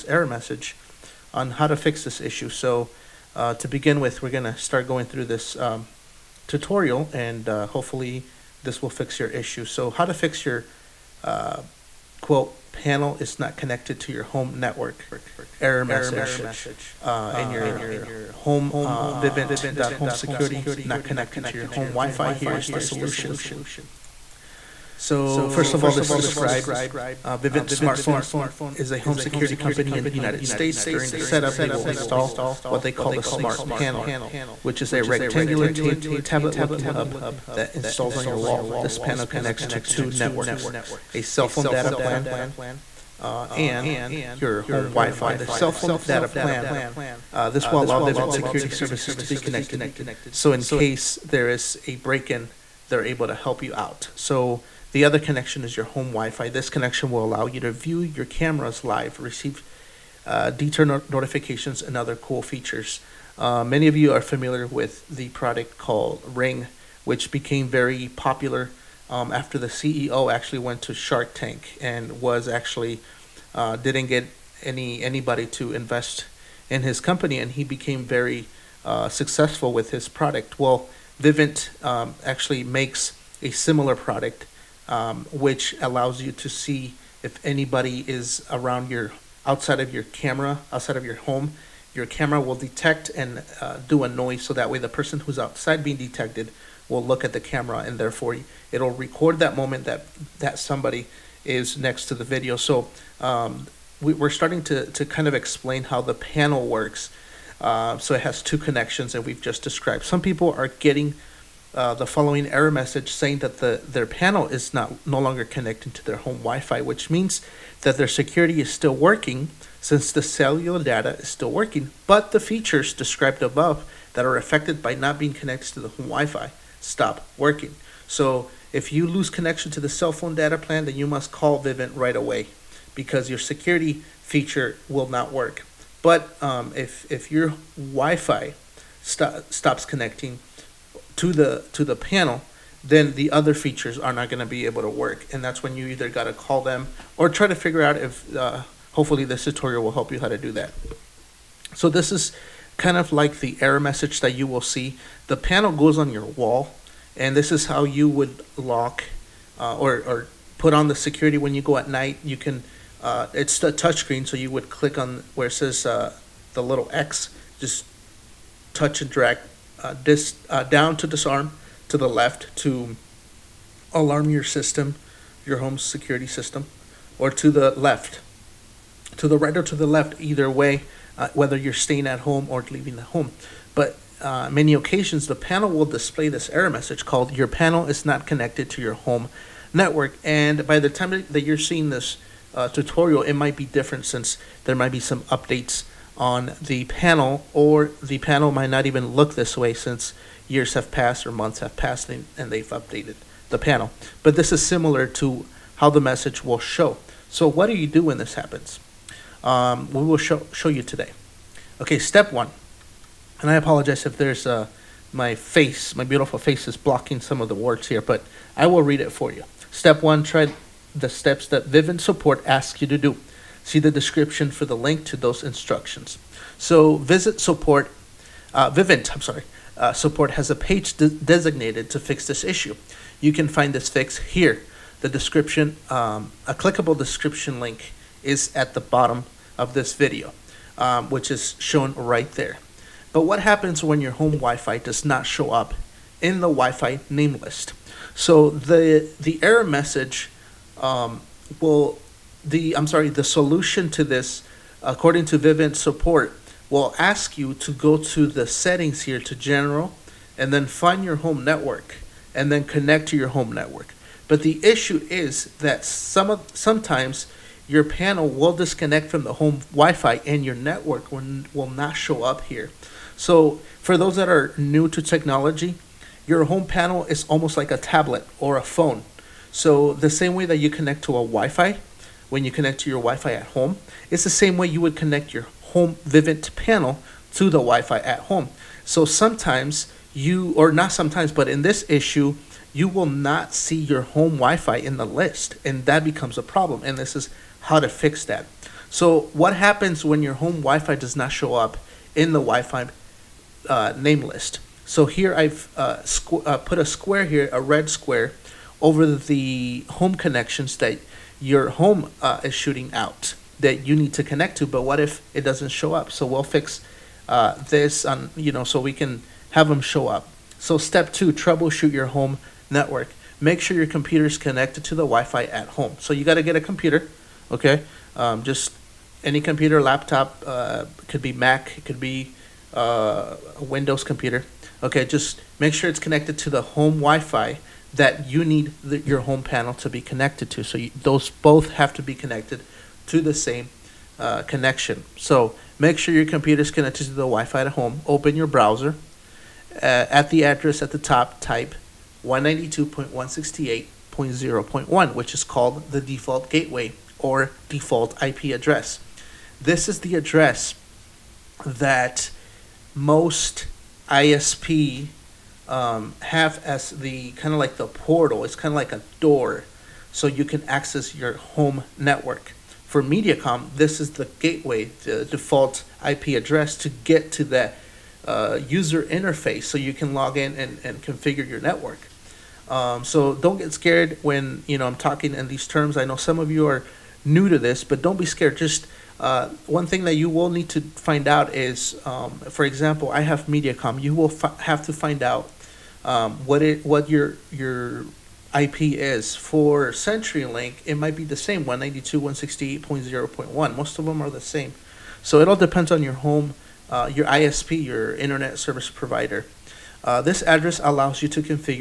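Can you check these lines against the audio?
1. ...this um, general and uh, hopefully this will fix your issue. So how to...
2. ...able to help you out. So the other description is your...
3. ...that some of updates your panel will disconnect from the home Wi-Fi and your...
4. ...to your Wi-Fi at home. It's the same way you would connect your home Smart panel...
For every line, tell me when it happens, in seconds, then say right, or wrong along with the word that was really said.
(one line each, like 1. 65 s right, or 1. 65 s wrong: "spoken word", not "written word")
1. 5 s wrong: "tutorial", not "general"
2. 53 s wrong: "connection", not "description"
3. 265 s wrong: "sometimes", not "updates"
4. 282 s wrong: "Vivint", not "Smart".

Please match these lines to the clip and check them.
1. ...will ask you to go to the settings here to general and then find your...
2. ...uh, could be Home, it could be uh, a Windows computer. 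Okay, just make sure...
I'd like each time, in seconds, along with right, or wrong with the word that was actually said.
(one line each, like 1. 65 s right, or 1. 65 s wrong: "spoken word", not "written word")
1. 256 s right
2. 330 s wrong: "Mac", not "Home".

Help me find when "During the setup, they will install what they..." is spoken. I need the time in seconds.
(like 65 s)
30 s.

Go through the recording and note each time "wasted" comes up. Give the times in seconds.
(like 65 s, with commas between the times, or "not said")
not said.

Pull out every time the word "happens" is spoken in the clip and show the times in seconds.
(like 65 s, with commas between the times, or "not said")
208 s, 243 s, 299 s.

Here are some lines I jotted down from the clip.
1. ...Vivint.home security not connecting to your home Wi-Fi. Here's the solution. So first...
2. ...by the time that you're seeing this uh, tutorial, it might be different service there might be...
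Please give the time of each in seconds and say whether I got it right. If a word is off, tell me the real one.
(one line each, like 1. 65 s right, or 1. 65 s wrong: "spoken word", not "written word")
1. 19 s right
2. 190 s wrong: "since", not "service".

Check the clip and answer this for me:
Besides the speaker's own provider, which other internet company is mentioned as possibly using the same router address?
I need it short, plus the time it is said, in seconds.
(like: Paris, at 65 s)
CenturyLink, at 399 s.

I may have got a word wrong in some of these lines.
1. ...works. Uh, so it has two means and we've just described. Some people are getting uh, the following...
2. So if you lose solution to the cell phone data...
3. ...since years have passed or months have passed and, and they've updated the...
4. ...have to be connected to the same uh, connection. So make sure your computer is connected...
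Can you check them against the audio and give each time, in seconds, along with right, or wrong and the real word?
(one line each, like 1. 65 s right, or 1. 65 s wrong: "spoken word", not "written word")
1. 106 s wrong: "connections", not "means"
2. 128 s wrong: "connection", not "solution"
3. 199 s right
4. 341 s right.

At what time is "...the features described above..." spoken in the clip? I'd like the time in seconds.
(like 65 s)
122 s.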